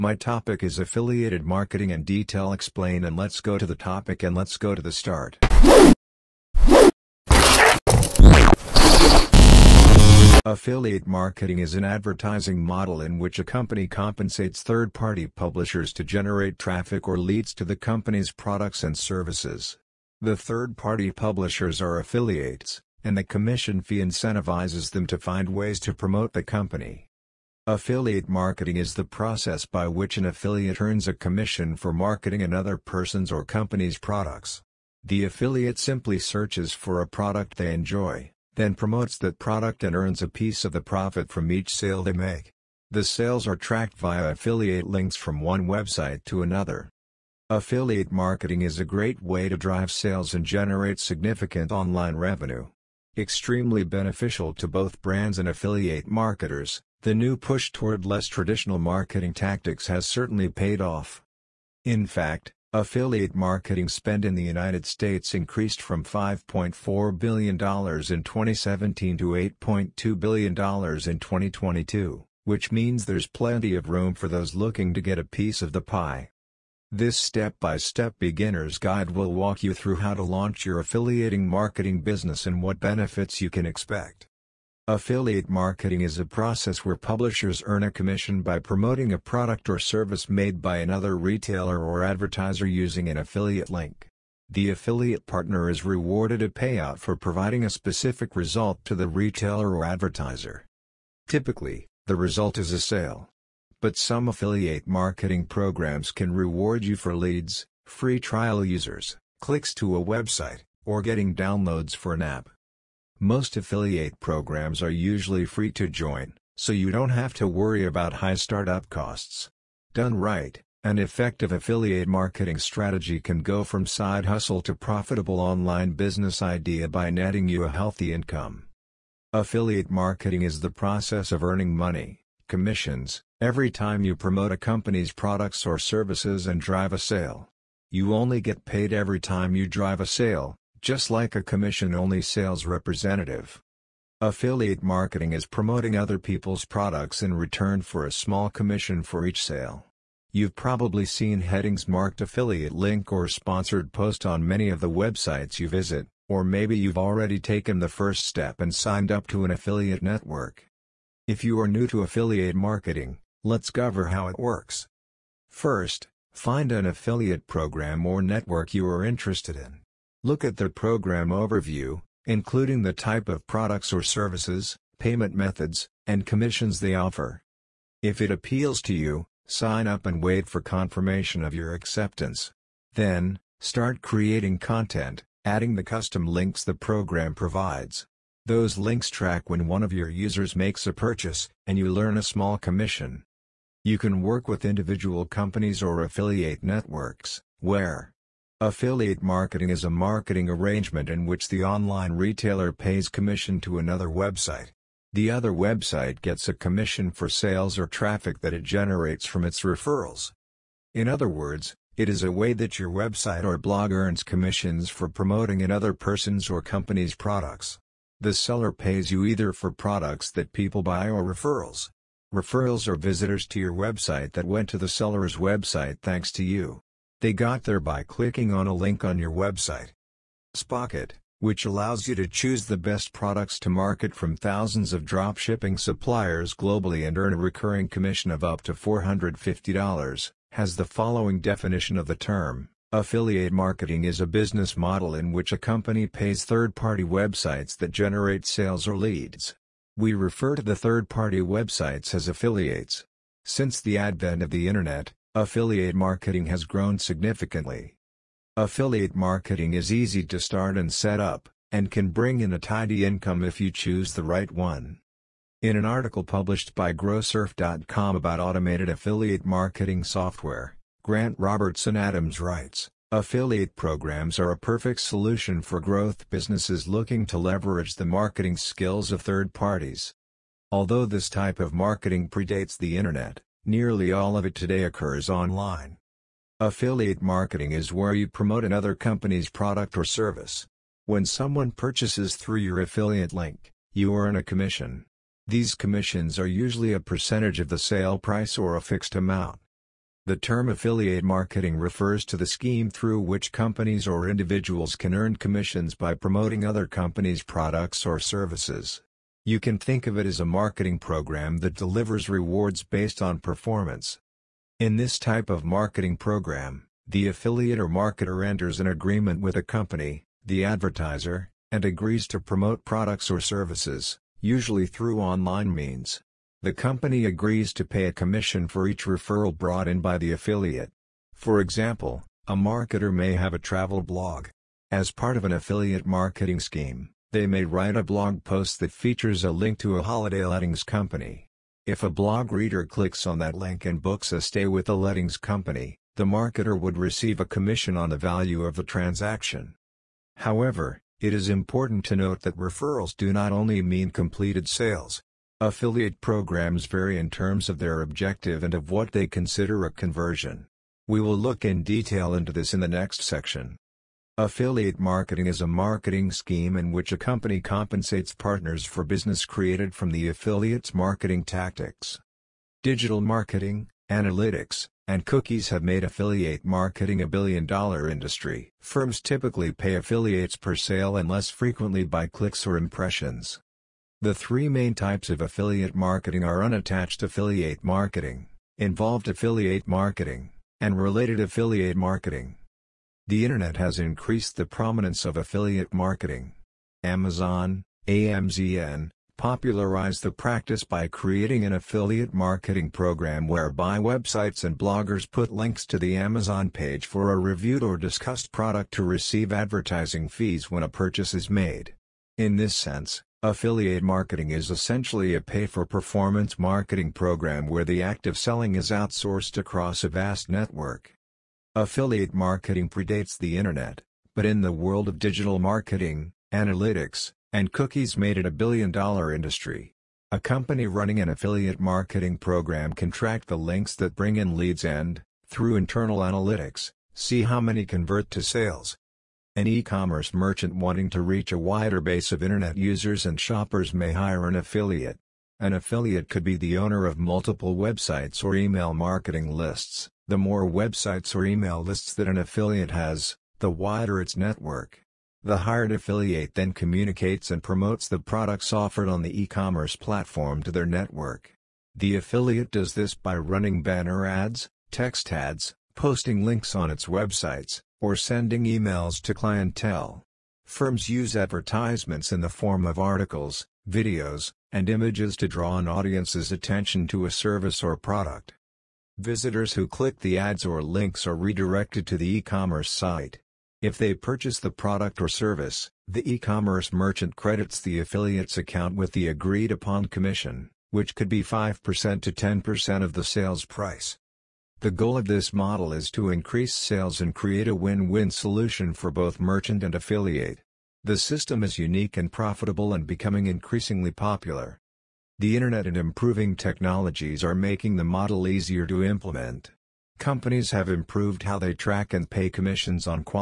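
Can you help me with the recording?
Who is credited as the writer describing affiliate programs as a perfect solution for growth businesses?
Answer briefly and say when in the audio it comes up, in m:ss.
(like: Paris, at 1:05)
Grant Robertson Adams, at 4:31.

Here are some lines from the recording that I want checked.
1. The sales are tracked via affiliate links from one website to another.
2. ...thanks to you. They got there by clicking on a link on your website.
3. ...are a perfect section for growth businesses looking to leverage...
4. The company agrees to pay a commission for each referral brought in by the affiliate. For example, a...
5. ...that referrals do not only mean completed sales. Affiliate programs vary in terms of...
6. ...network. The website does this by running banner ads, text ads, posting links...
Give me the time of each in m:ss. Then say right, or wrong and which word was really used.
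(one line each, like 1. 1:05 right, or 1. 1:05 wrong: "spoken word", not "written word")
1. 0:42 right
2. 3:46 right
3. 4:34 wrong: "solution", not "section"
4. 5:26 right
5. 5:52 right
6. 7:40 wrong: "affiliate", not "website".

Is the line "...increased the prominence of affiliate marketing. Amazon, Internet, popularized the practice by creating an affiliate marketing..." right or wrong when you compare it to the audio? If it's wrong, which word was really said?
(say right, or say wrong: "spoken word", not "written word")
wrong: "AMZN", not "Internet".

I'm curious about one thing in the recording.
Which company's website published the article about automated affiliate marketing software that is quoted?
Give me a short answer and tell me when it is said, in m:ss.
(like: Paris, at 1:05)
Growsurf.com, at 4:26.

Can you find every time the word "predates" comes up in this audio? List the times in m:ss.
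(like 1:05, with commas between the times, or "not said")
4:42, 7:02.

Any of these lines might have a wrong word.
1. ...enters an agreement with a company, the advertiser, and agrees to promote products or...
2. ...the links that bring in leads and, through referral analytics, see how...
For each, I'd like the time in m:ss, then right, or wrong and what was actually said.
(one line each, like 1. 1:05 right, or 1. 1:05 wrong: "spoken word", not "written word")
1. 5:18 right
2. 7:13 wrong: "internal", not "referral".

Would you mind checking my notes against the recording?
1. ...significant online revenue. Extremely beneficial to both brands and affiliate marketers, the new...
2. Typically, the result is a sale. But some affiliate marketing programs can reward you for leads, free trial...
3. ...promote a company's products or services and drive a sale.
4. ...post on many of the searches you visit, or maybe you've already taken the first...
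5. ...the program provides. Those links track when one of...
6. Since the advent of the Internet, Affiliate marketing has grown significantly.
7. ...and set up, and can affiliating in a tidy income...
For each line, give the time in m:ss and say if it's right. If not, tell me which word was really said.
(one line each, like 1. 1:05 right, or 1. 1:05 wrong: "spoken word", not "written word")
1. 0:51 right
2. 1:41 right
3. 2:14 right
4. 2:33 wrong: "websites", not "searches"
5. 3:06 right
6. 4:13 right
7. 4:20 wrong: "bring", not "affiliating".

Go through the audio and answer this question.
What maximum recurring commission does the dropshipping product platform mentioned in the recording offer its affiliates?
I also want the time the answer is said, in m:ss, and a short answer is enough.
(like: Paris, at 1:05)
$450, at 3:58.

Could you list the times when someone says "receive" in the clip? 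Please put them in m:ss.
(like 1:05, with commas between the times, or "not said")
5:46, 6:49.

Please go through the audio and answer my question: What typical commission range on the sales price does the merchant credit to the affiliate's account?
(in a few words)
5% to 10%.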